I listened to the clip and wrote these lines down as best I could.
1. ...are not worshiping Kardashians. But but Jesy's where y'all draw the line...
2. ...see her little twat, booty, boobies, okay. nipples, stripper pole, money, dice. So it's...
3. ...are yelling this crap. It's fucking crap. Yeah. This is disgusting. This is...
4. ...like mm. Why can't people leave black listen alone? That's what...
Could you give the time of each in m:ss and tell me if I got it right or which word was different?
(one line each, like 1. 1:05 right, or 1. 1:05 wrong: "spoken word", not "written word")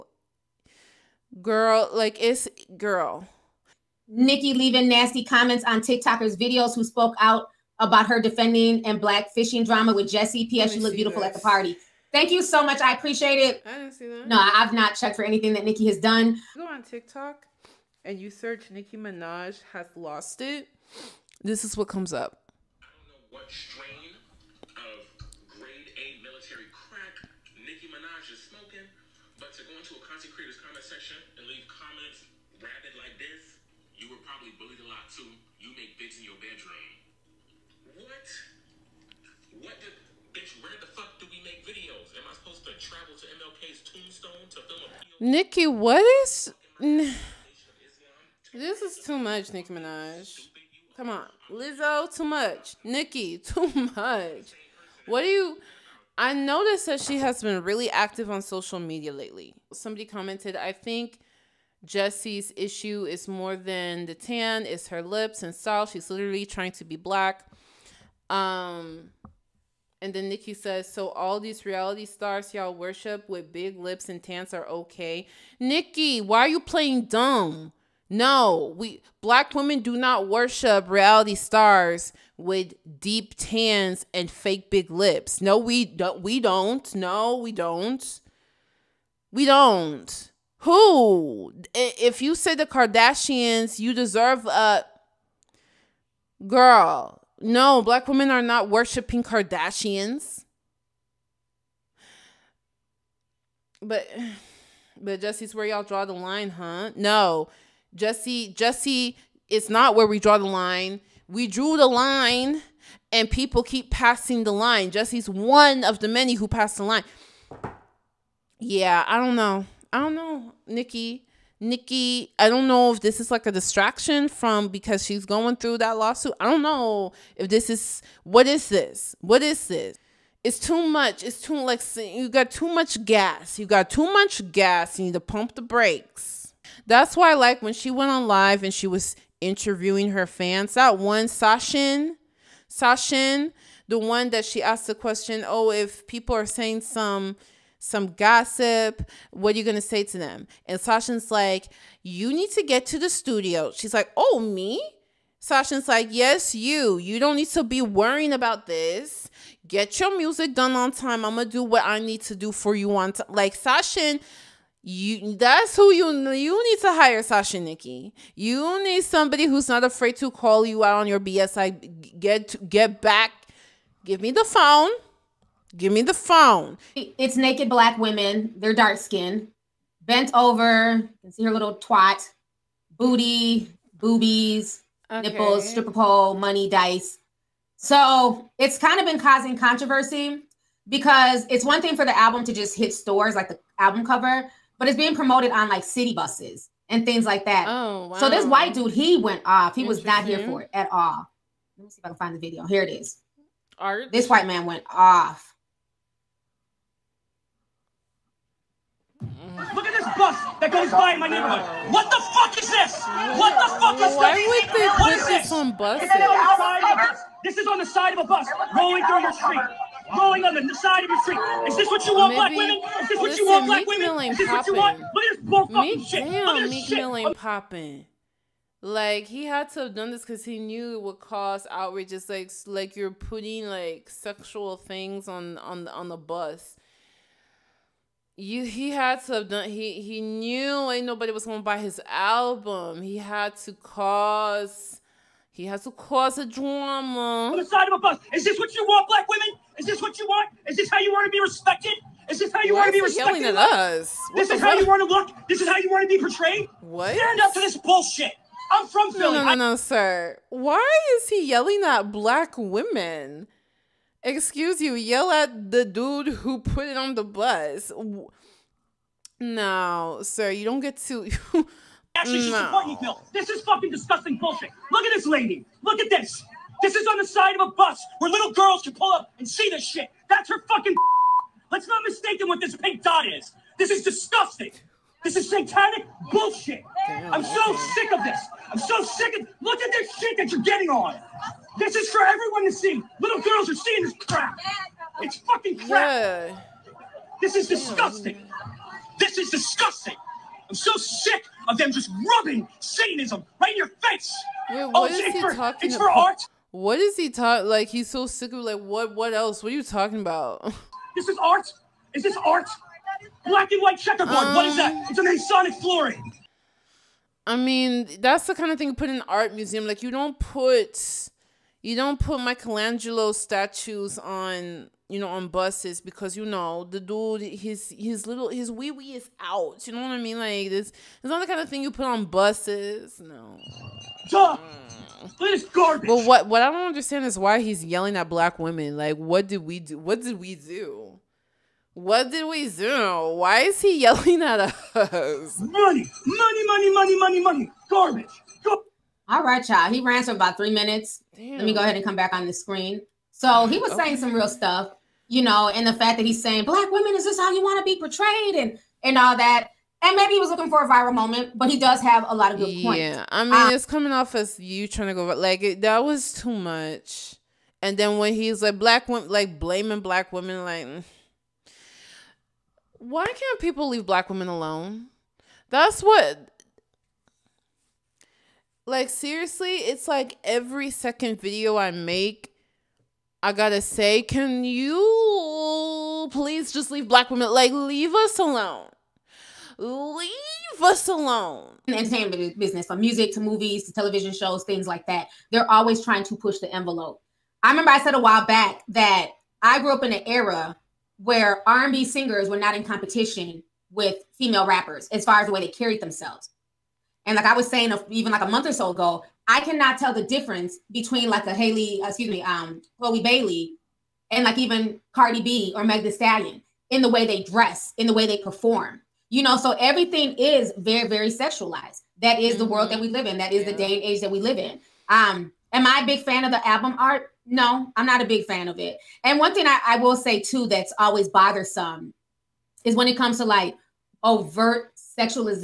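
1. 1:38 right
2. 3:01 right
3. 4:53 wrong: "seeing", not "yelling"
4. 6:10 wrong: "women", not "listen".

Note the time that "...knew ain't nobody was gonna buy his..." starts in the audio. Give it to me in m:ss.
4:00.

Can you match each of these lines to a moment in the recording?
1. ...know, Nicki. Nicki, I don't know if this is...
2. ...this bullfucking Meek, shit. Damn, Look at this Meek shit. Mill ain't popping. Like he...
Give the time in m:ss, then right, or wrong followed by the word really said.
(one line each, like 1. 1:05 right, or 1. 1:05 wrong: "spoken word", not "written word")
1. 2:00 right
2. 3:45 right.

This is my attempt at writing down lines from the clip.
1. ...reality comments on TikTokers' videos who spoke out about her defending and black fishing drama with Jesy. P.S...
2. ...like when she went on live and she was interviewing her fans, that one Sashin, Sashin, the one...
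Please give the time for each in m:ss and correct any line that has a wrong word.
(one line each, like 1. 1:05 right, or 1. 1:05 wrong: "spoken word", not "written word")
1. 0:04 wrong: "nasty", not "reality"
2. 2:17 right.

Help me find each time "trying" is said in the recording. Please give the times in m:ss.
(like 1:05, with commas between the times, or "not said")
1:06, 6:04, 6:36.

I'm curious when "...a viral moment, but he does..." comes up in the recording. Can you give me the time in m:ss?
6:00.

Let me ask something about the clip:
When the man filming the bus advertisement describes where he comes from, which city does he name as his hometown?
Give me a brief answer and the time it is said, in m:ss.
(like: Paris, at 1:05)
Philly, at 4:19.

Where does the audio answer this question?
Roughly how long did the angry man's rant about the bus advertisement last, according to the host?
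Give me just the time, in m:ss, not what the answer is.
5:50.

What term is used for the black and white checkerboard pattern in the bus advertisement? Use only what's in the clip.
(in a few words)
Masonic flooring.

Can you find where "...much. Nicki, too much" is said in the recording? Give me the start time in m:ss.
0:52.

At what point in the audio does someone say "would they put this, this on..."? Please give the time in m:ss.
3:34.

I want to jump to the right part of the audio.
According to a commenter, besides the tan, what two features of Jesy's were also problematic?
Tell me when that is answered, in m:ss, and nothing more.
1:04.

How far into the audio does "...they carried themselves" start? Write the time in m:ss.
6:45.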